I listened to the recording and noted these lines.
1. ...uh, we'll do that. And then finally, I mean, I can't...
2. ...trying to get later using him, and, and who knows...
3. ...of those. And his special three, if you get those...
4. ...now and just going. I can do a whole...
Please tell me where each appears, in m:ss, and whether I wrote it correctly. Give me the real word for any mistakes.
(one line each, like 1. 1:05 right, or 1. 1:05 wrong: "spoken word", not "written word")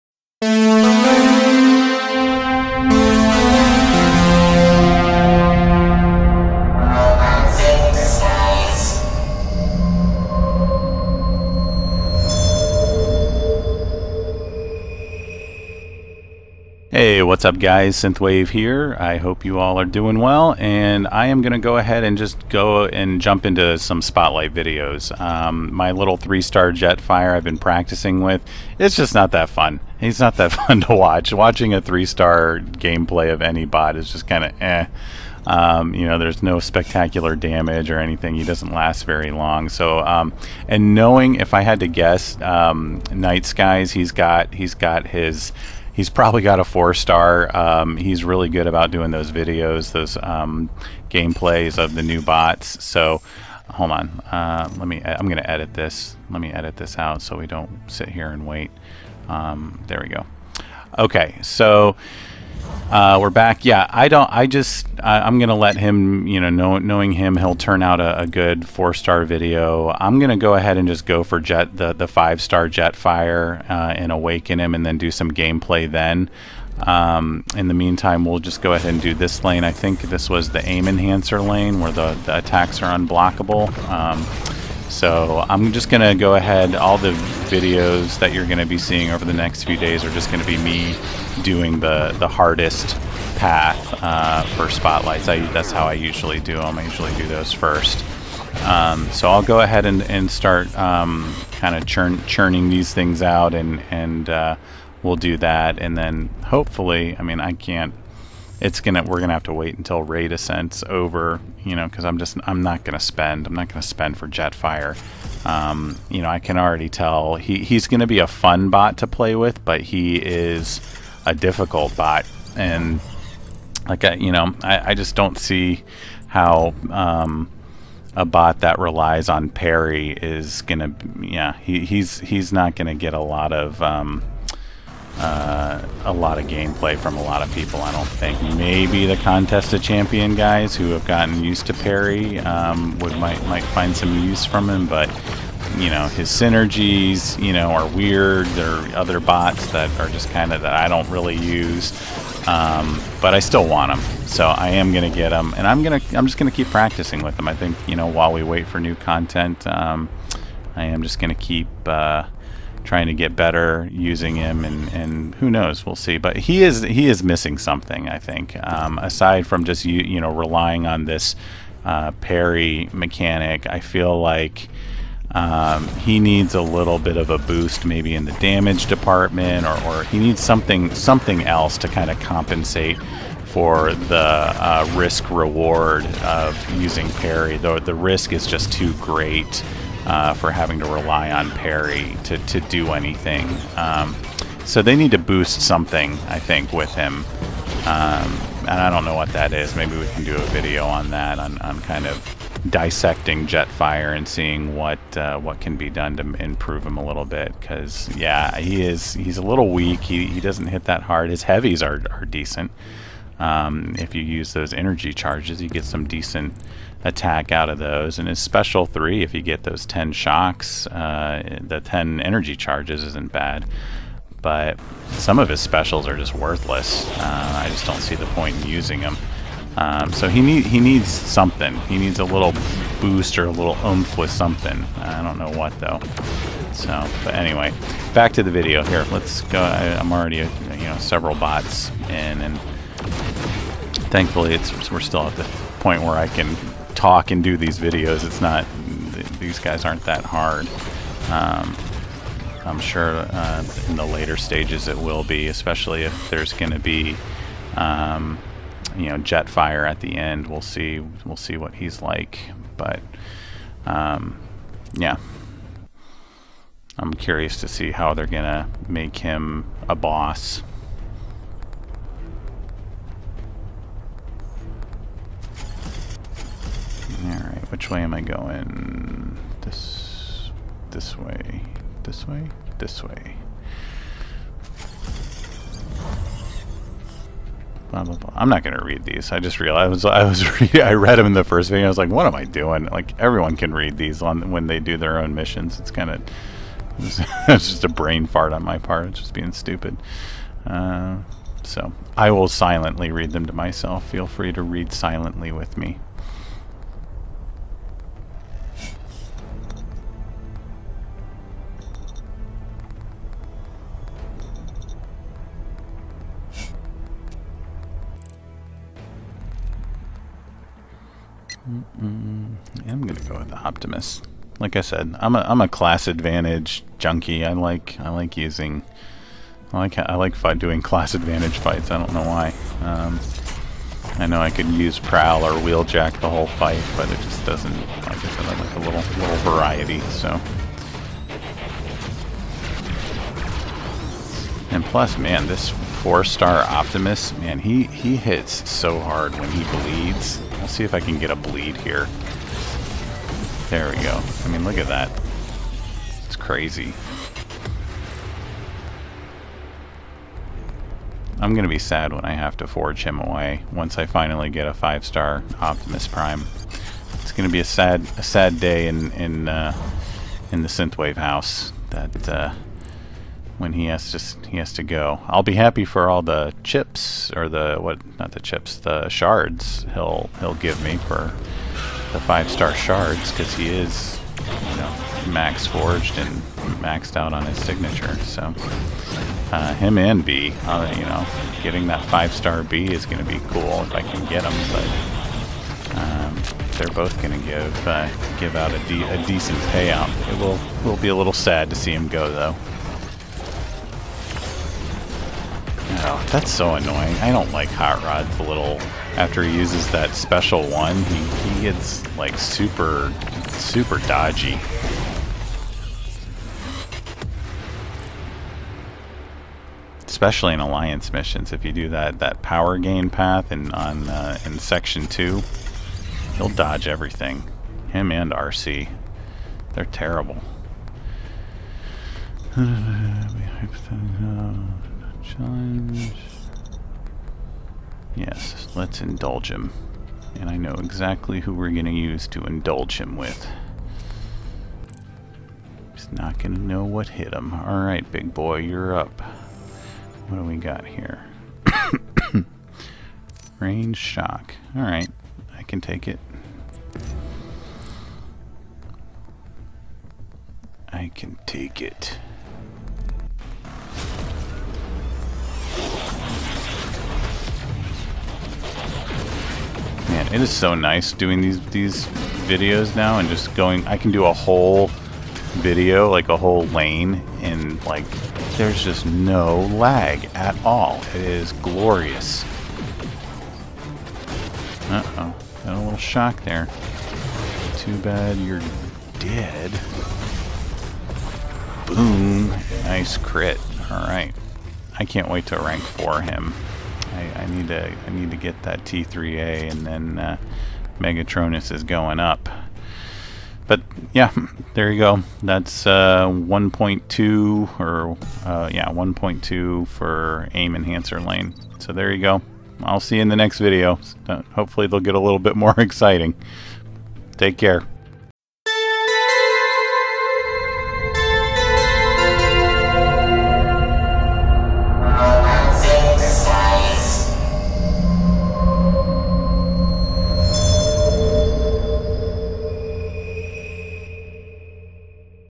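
1. 1:44 wrong: "hopefully", not "finally"
2. 2:42 wrong: "better", not "later"
3. 3:37 right
4. 7:52 right.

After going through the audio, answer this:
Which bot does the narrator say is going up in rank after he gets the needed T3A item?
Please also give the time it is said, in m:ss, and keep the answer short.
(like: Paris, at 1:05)
Megatronus, at 8:20.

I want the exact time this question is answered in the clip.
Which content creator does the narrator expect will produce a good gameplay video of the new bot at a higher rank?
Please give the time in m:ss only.
0:43.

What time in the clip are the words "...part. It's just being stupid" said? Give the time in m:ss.
4:58.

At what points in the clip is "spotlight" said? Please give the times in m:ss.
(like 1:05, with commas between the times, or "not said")
0:24, 1:34.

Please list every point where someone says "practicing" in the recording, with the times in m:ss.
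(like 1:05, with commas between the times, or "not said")
0:27, 2:36.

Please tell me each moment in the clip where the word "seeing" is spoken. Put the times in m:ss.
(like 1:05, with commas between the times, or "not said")
1:28, 3:24.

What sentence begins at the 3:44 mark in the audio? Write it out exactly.
But some of his specials are just worthless.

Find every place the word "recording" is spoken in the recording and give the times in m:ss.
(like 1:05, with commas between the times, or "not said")
not said.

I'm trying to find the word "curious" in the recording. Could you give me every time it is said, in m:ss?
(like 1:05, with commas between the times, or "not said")
4:27.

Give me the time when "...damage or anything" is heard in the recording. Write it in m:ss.
0:37.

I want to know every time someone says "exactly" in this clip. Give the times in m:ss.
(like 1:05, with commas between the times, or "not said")
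7:20.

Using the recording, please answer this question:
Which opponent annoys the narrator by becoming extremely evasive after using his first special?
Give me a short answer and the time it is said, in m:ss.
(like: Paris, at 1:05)
Hot Rod, at 6:47.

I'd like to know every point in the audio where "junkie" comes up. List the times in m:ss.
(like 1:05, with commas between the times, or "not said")
5:26.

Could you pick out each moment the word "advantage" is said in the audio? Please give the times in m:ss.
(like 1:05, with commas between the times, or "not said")
5:26, 5:31.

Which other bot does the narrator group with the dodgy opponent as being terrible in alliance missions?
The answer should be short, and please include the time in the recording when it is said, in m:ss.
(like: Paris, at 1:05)
Arcee, at 7:08.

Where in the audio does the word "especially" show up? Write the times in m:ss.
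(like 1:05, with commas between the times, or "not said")
4:15, 7:00.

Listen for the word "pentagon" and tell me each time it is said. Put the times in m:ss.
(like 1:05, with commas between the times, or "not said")
not said.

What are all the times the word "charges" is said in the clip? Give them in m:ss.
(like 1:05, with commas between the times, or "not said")
3:35, 3:42.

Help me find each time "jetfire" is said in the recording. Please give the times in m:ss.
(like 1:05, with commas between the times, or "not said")
0:26, 1:54, 3:23, 4:19.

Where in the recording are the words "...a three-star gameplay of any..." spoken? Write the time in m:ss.
0:31.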